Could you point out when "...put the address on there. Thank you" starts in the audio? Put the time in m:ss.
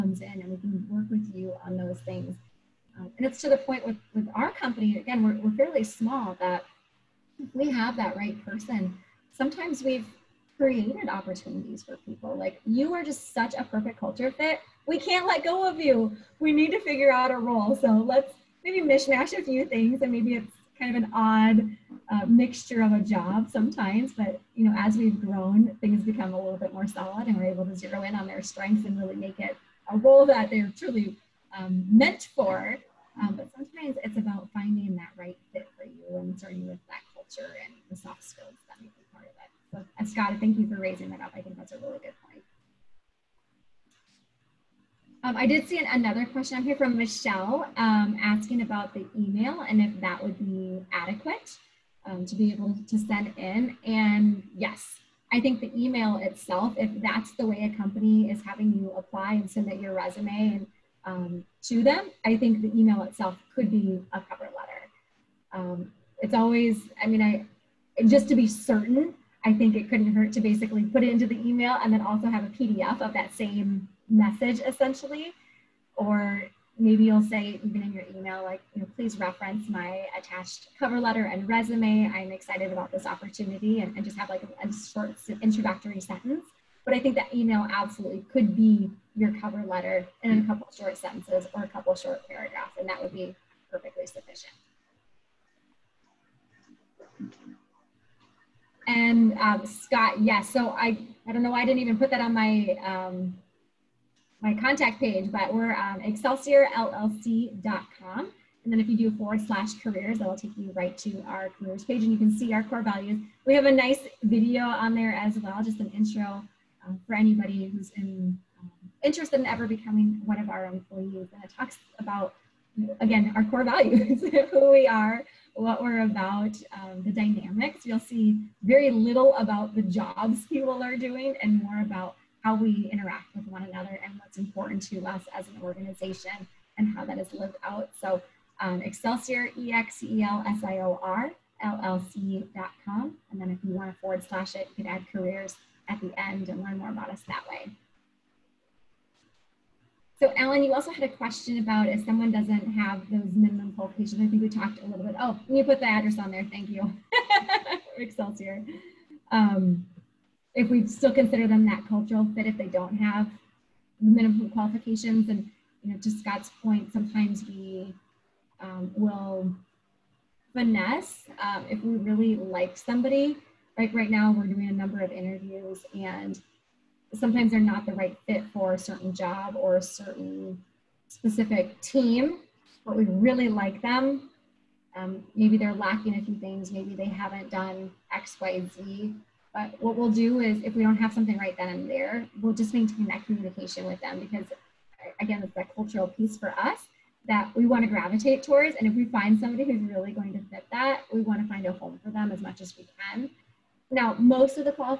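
2:35.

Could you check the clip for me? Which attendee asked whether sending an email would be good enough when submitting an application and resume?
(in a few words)
Michelle.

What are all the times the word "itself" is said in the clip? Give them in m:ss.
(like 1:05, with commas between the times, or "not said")
0:56, 1:03.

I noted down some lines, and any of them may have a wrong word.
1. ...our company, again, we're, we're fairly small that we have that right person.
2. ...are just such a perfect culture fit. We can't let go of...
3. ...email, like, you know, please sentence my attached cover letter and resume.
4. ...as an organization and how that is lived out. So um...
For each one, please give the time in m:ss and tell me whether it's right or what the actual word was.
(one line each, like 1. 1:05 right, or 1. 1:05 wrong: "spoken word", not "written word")
1. 0:04 right
2. 0:12 right
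3. 1:18 wrong: "reference", not "sentence"
4. 2:15 right.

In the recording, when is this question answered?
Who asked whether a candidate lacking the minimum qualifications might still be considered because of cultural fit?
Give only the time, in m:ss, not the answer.
2:30.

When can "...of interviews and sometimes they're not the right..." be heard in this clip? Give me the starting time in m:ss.
2:54.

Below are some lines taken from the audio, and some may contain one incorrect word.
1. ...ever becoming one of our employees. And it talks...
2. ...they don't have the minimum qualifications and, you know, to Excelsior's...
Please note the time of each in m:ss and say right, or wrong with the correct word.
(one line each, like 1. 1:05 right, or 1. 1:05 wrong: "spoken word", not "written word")
1. 1:59 right
2. 2:42 wrong: "Scott", not "Excelsior".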